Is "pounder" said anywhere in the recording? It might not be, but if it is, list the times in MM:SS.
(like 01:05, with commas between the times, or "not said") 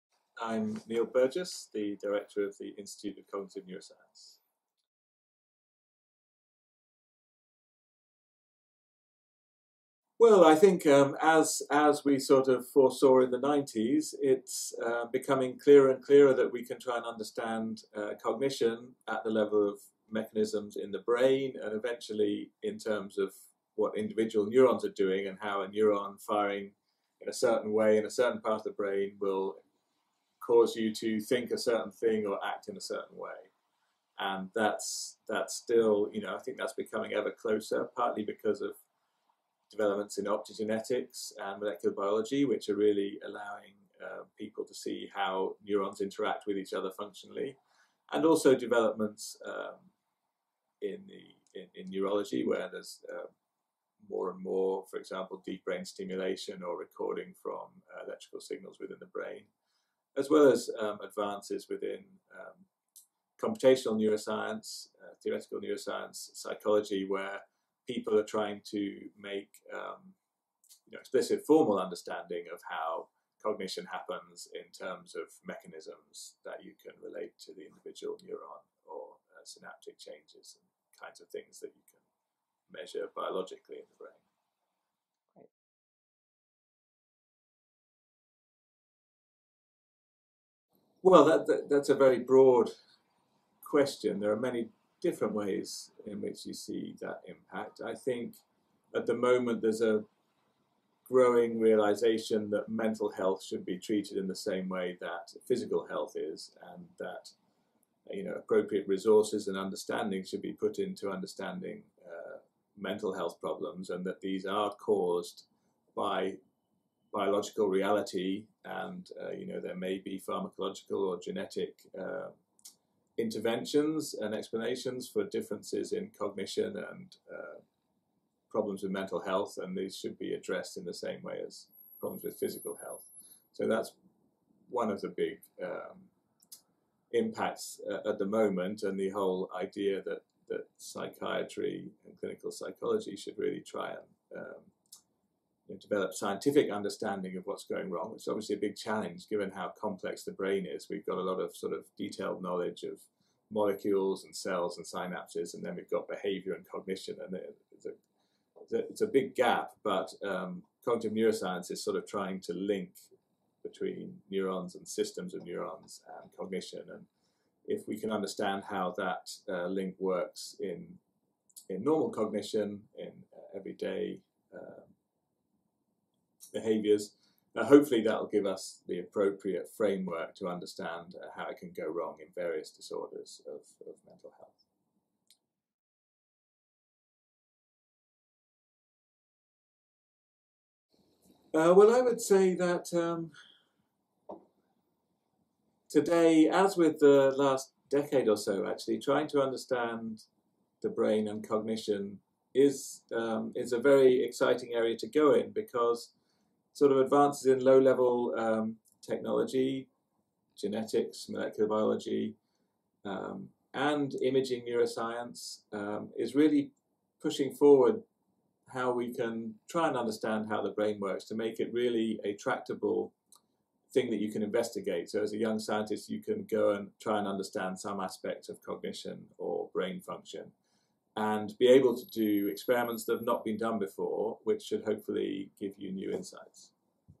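not said.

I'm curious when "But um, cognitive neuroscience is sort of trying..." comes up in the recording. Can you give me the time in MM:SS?
02:39.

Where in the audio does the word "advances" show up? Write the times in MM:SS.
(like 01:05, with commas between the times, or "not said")
01:01, 03:26.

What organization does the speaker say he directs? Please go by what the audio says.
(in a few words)
Institute of Cognitive Neuroscience.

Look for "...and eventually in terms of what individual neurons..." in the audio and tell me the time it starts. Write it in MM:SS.
00:21.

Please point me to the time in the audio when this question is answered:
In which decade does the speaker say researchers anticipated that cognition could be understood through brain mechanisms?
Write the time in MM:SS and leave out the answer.
00:13.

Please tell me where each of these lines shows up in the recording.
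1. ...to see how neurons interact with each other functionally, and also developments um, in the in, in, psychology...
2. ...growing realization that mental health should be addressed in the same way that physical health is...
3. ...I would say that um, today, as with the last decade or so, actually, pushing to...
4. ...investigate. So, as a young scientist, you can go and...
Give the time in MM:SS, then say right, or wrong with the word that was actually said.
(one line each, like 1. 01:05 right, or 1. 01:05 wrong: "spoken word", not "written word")
1. 00:44 wrong: "neurology", not "psychology"
2. 01:41 wrong: "treated", not "addressed"
3. 03:11 wrong: "trying", not "pushing"
4. 03:44 right.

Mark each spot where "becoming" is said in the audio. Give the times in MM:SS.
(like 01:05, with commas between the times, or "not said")
00:15, 00:36.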